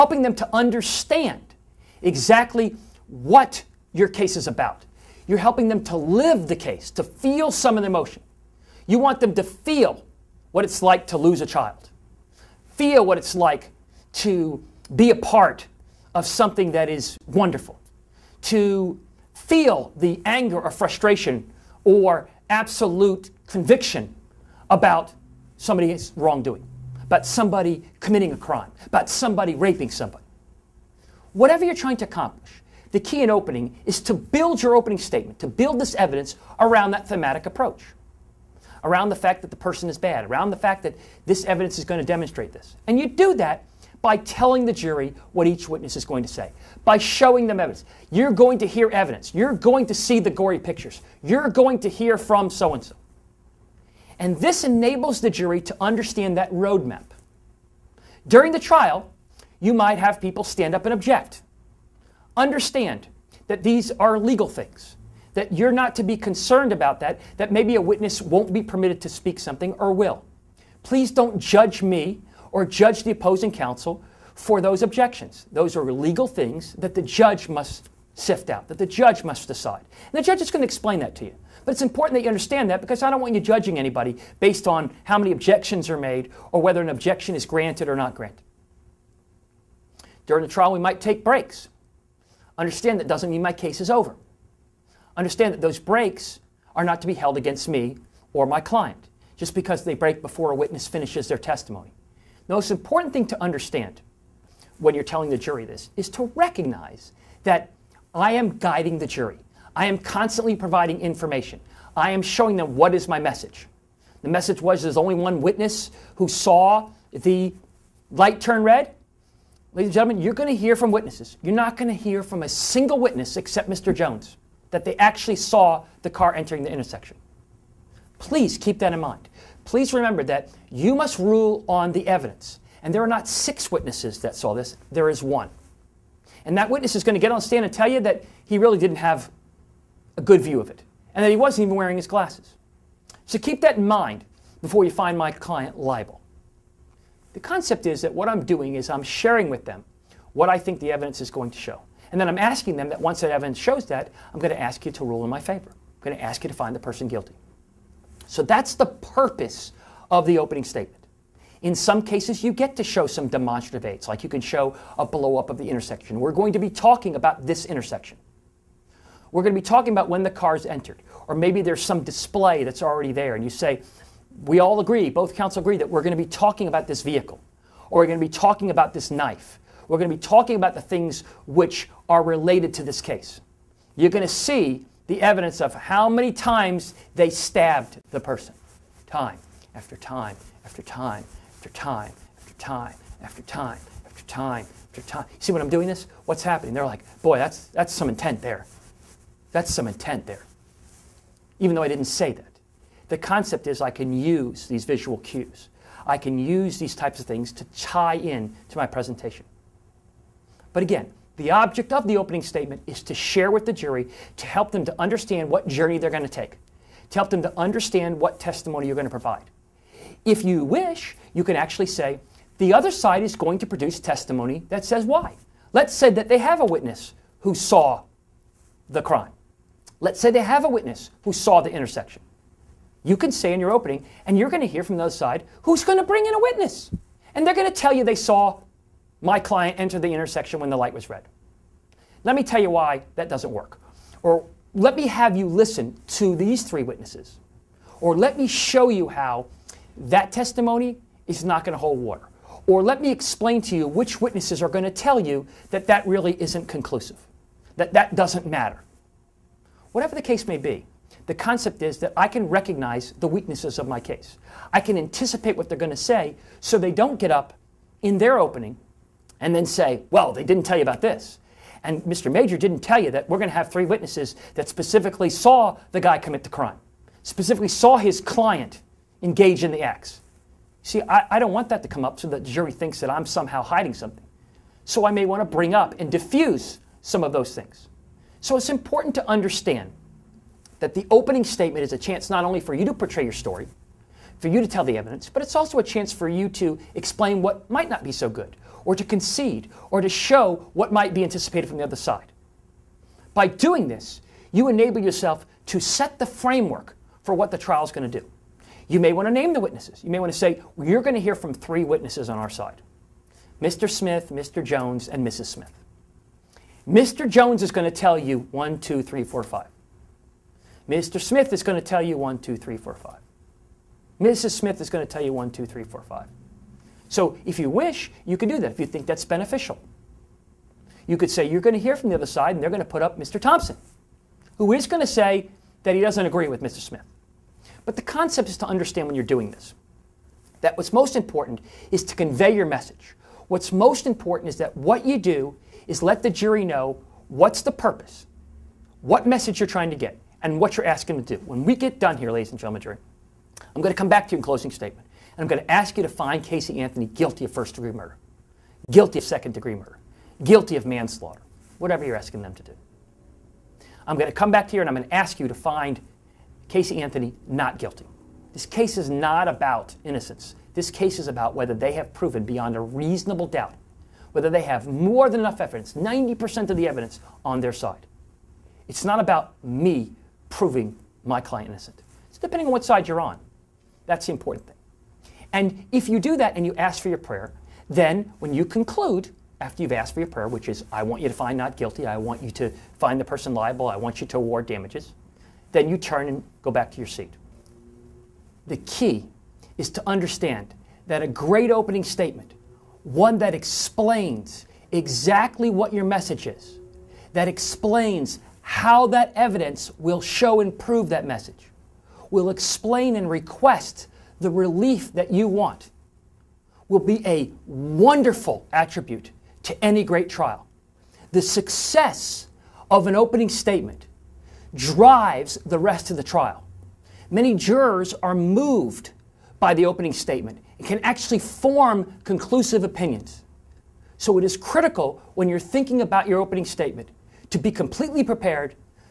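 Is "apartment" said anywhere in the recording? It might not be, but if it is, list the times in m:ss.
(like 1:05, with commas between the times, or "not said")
not said.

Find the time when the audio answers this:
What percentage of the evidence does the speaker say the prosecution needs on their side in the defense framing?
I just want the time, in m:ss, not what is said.
6:15.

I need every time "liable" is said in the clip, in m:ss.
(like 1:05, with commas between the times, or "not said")
2:25, 6:33.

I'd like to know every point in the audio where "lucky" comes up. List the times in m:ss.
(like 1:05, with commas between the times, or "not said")
not said.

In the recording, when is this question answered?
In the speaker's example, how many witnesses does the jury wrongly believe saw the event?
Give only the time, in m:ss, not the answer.
2:13.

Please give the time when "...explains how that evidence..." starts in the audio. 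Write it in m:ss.
6:47.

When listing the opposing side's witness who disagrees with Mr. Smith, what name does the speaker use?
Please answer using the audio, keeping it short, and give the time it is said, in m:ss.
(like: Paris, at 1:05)
Mr. Thompson, at 5:33.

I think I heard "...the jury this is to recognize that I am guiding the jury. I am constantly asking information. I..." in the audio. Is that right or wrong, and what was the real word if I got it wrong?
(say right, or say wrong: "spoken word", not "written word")
wrong: "providing", not "asking".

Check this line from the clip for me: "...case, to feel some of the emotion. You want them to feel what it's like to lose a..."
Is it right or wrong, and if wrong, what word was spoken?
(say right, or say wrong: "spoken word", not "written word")
right.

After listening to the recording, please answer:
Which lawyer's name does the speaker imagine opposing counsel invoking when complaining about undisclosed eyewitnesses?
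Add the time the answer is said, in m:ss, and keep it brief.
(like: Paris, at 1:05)
Mr. Mager, at 4:32.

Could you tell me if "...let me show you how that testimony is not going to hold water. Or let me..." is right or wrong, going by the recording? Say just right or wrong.
right.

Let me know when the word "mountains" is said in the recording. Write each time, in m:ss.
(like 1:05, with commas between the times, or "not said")
not said.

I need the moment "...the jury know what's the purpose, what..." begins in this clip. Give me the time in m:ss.
5:46.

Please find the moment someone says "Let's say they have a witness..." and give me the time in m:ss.
3:49.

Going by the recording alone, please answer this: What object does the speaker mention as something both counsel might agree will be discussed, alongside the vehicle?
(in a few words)
knife.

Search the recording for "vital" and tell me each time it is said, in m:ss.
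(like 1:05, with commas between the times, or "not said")
not said.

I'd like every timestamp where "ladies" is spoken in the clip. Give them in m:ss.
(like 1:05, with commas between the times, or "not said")
1:59, 5:52.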